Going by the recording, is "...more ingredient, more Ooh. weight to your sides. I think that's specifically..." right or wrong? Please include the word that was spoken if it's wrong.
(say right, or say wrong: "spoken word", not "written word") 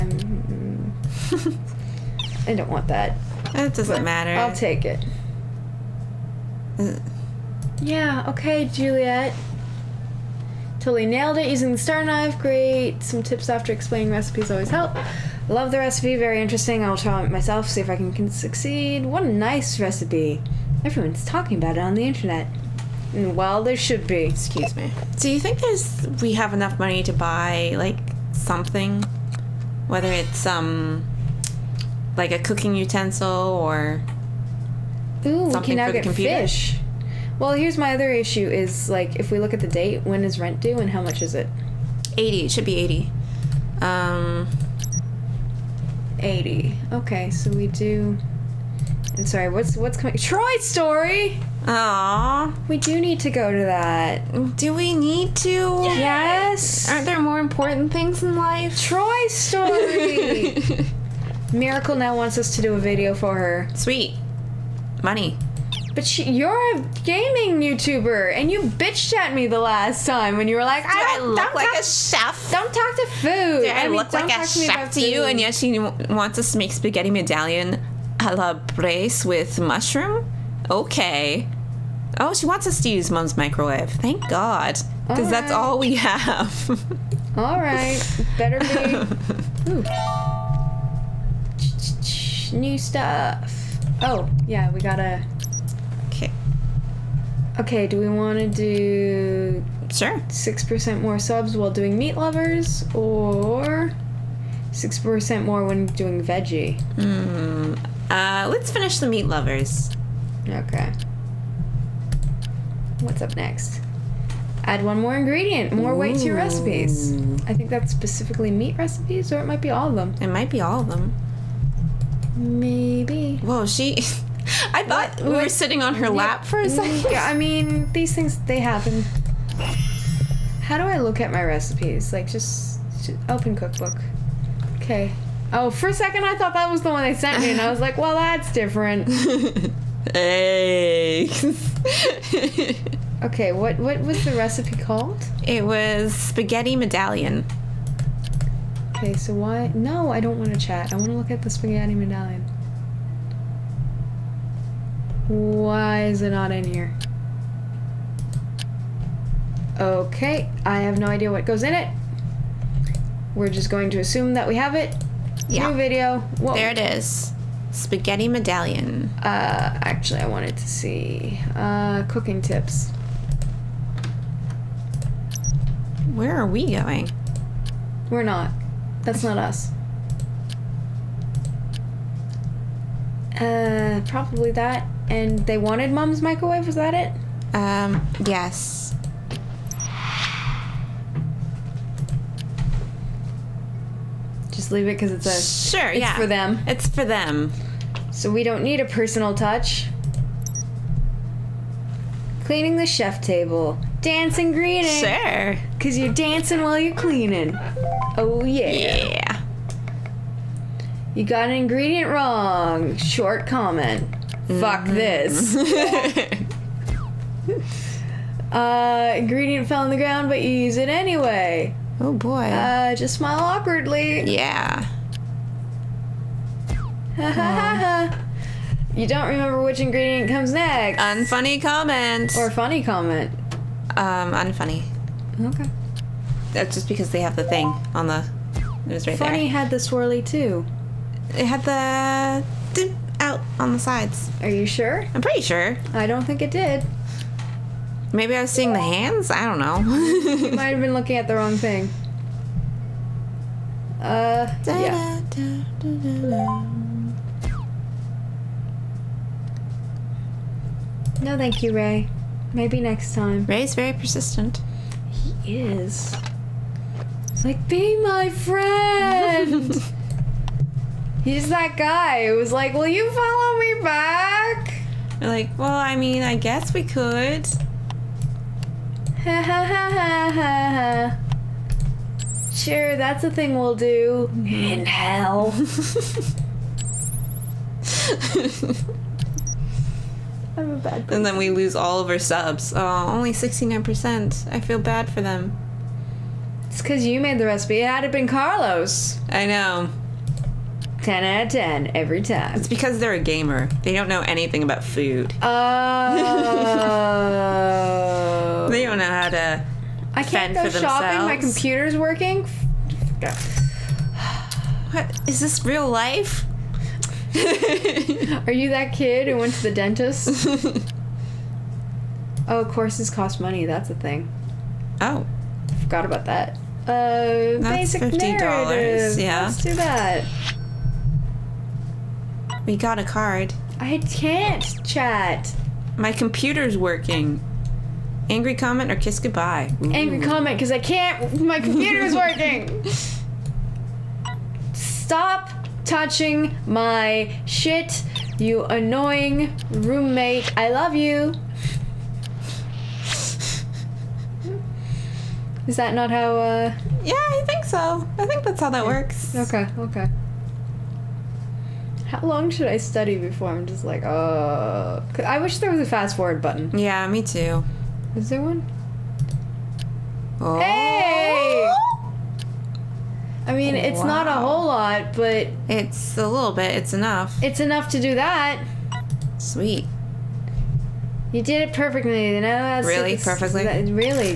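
wrong: "recipes", not "sides".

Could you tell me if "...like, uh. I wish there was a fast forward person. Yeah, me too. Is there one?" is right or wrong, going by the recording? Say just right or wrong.
wrong.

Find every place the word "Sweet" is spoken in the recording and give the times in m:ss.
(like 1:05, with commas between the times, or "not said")
1:03, 6:19.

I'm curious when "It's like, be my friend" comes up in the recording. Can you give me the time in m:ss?
4:27.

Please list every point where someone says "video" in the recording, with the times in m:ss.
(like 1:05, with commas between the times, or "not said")
1:02, 2:45.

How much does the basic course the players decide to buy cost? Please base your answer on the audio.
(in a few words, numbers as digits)
$50.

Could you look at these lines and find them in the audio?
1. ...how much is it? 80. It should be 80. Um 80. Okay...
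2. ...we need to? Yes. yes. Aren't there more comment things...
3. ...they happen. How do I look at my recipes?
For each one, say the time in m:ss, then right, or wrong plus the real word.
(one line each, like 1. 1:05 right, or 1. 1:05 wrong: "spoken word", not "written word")
1. 0:40 right
2. 0:54 wrong: "important", not "comment"
3. 2:08 right.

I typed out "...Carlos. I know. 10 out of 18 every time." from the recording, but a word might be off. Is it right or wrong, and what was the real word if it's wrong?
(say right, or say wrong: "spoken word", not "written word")
wrong: "10", not "18".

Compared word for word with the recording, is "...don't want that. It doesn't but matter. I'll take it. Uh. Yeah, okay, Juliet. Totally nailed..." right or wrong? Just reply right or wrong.
right.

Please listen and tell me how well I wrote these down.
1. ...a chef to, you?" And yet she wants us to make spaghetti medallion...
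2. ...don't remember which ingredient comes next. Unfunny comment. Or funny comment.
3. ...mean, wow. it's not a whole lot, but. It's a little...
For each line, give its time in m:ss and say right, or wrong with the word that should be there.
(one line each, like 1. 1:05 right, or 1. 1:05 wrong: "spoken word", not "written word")
1. 1:14 right
2. 3:49 right
3. 6:13 right.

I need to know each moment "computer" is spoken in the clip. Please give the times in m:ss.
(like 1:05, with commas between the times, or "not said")
0:36, 5:11, 5:36, 5:41.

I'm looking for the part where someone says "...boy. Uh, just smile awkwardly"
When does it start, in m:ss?
3:42.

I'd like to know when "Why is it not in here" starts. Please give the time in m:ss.
2:35.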